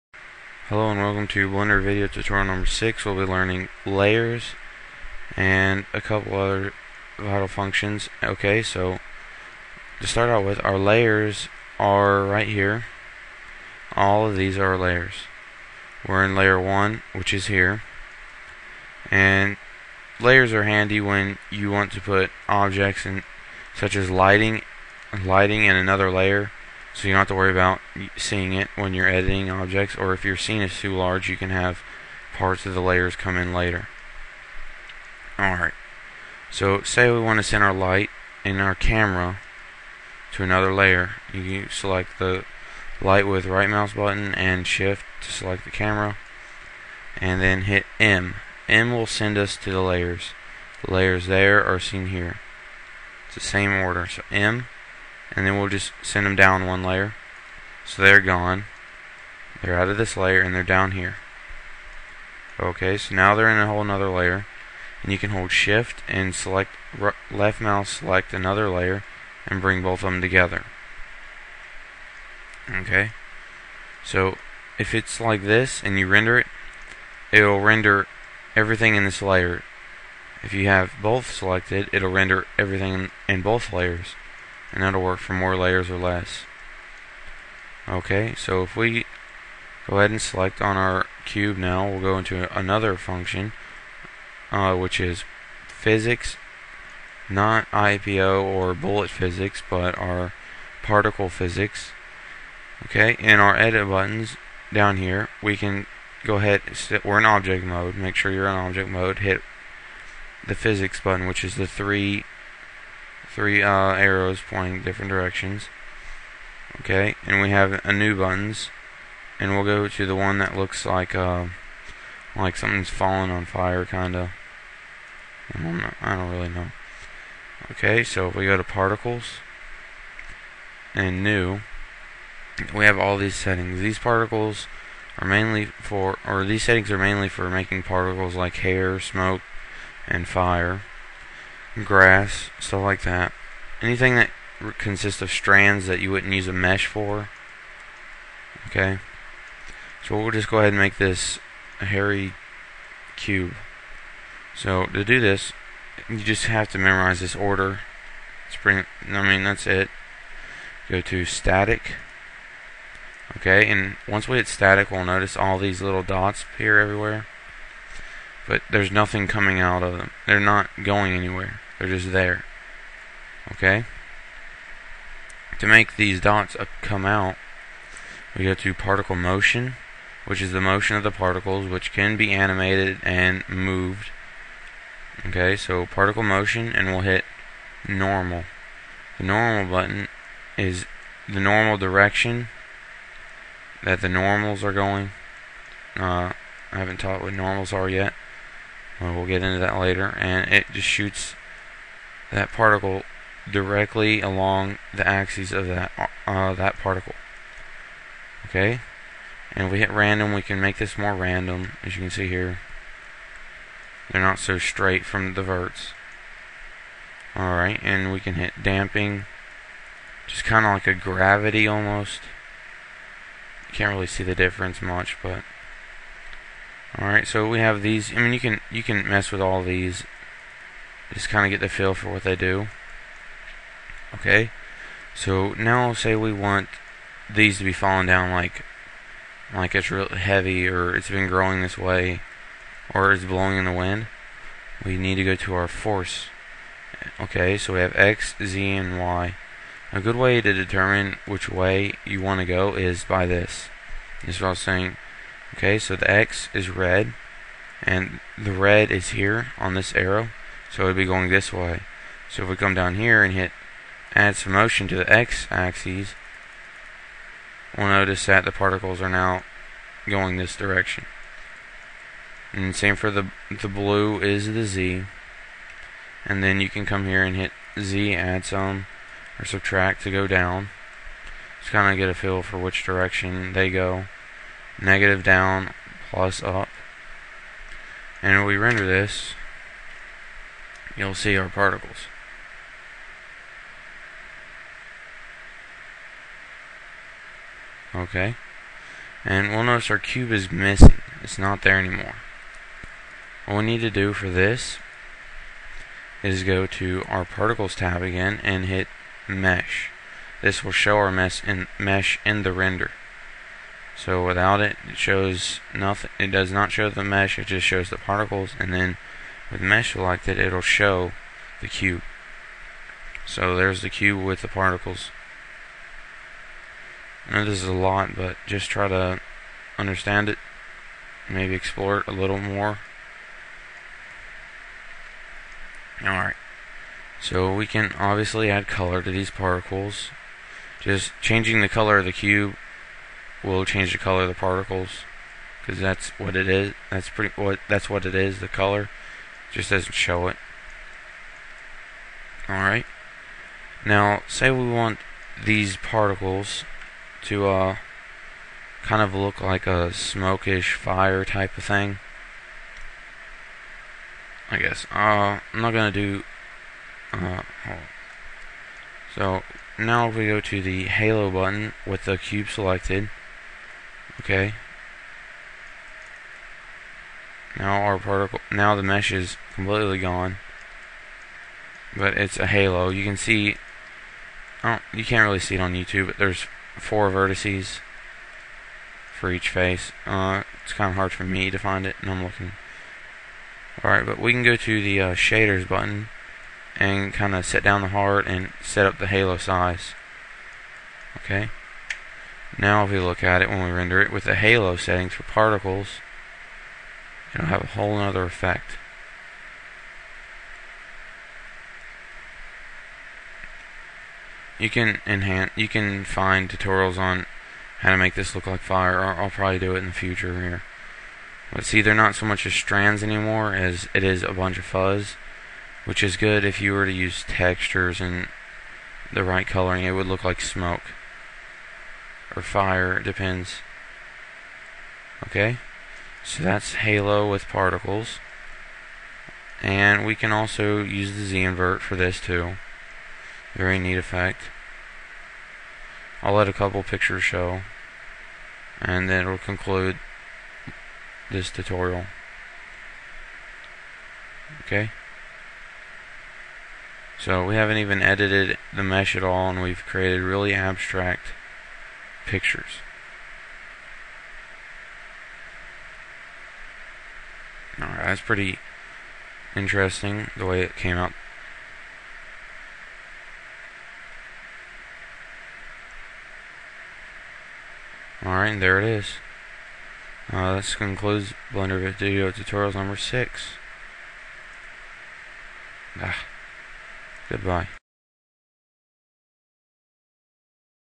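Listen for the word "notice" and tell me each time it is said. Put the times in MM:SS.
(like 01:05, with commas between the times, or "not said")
02:45, 04:27, 04:59.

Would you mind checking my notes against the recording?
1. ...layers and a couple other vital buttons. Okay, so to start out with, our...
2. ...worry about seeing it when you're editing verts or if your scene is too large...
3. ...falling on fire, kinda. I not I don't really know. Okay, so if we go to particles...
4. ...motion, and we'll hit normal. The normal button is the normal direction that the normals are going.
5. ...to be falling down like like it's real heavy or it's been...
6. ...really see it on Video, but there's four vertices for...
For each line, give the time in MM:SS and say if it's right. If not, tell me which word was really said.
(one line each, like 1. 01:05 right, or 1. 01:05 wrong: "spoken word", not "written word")
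1. 00:03 wrong: "functions", not "buttons"
2. 00:27 wrong: "objects", not "verts"
3. 02:02 right
4. 03:06 right
5. 03:57 right
6. 06:25 wrong: "YouTube", not "Video".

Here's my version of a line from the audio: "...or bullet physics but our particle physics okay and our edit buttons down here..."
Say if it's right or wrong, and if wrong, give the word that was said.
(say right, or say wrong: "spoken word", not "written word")
right.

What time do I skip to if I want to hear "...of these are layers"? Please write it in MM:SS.
00:14.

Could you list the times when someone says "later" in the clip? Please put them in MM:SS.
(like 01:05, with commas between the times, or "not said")
00:33, 03:19.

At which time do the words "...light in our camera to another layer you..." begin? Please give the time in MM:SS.
00:37.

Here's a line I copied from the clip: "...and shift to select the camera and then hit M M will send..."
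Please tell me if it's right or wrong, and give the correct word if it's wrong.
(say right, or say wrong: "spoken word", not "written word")
right.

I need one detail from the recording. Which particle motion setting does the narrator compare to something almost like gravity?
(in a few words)
damping.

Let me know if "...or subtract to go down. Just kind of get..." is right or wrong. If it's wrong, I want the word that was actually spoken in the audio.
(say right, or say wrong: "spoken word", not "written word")
right.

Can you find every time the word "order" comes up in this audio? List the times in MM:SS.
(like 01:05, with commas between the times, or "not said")
00:53, 02:37.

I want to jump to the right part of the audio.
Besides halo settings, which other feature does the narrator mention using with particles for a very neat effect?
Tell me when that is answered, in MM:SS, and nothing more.
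07:21.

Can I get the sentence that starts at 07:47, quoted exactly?
Alright, that's pretty interesting the way it came out.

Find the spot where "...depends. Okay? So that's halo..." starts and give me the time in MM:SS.
07:13.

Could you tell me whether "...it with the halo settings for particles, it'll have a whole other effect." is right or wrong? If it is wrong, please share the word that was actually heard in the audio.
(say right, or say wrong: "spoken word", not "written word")
right.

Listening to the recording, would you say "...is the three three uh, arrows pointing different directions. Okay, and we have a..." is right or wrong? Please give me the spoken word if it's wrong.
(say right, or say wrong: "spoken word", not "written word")
right.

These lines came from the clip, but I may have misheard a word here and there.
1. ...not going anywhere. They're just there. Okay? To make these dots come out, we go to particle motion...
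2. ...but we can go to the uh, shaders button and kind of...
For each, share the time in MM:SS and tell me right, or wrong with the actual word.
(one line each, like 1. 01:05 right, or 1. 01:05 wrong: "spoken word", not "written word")
1. 02:50 right
2. 06:34 right.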